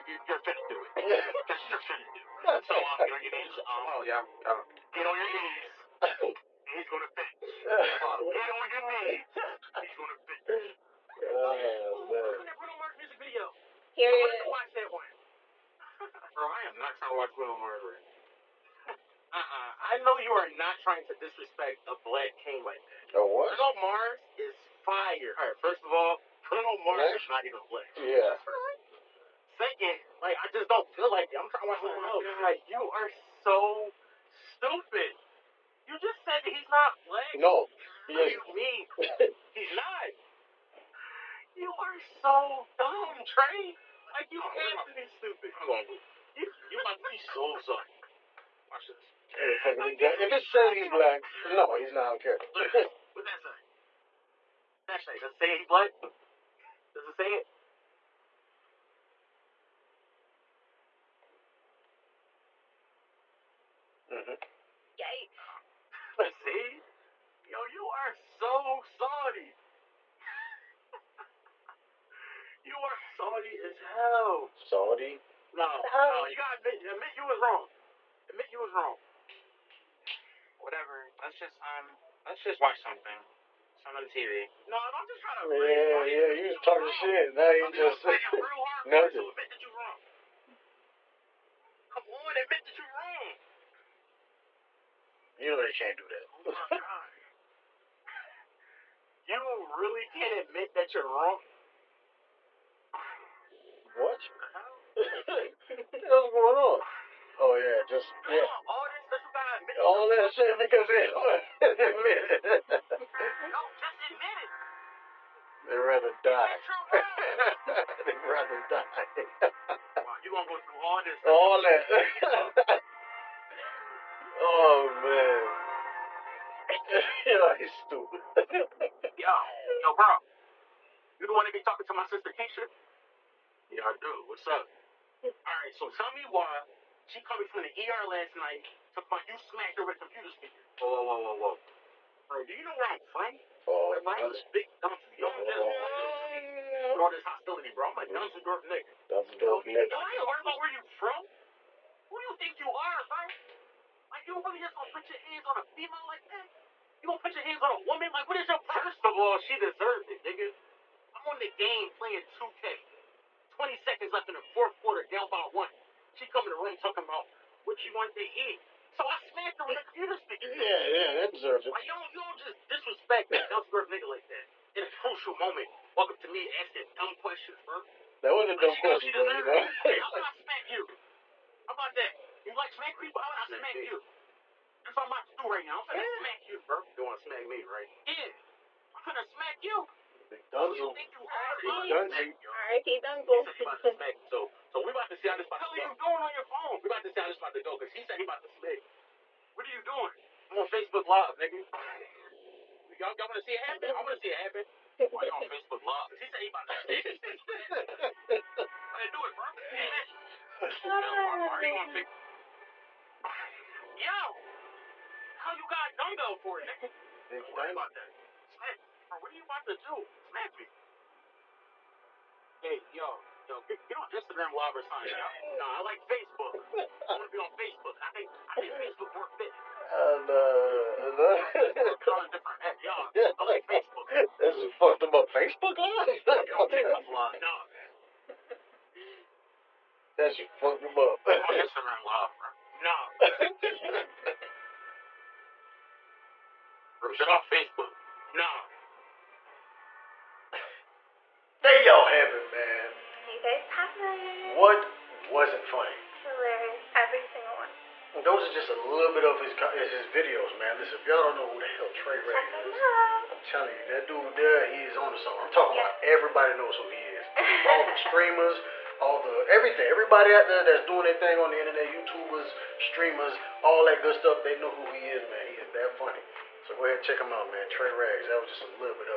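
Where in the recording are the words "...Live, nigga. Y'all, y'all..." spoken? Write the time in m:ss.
3:21.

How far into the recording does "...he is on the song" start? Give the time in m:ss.
4:24.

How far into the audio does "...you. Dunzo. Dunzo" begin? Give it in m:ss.
3:09.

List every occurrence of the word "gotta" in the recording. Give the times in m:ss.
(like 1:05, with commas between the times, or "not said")
1:16, 1:49.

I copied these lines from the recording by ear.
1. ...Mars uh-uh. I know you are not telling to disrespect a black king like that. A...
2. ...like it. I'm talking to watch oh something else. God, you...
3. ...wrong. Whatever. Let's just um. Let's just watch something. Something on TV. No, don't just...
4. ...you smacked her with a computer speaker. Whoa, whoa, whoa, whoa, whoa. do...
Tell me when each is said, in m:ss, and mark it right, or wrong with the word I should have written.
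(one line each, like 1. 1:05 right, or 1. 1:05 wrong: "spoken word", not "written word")
1. 0:17 wrong: "trying", not "telling"
2. 0:31 wrong: "trying", not "talking"
3. 1:18 right
4. 2:19 right.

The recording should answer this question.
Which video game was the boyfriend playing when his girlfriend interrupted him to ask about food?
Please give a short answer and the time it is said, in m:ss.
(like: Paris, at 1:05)
2K, at 2:42.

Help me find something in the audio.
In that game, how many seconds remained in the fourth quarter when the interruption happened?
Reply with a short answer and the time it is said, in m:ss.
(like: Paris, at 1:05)
20, at 2:43.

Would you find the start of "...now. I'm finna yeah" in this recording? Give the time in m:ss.
3:05.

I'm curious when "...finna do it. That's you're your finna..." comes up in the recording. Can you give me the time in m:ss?
0:00.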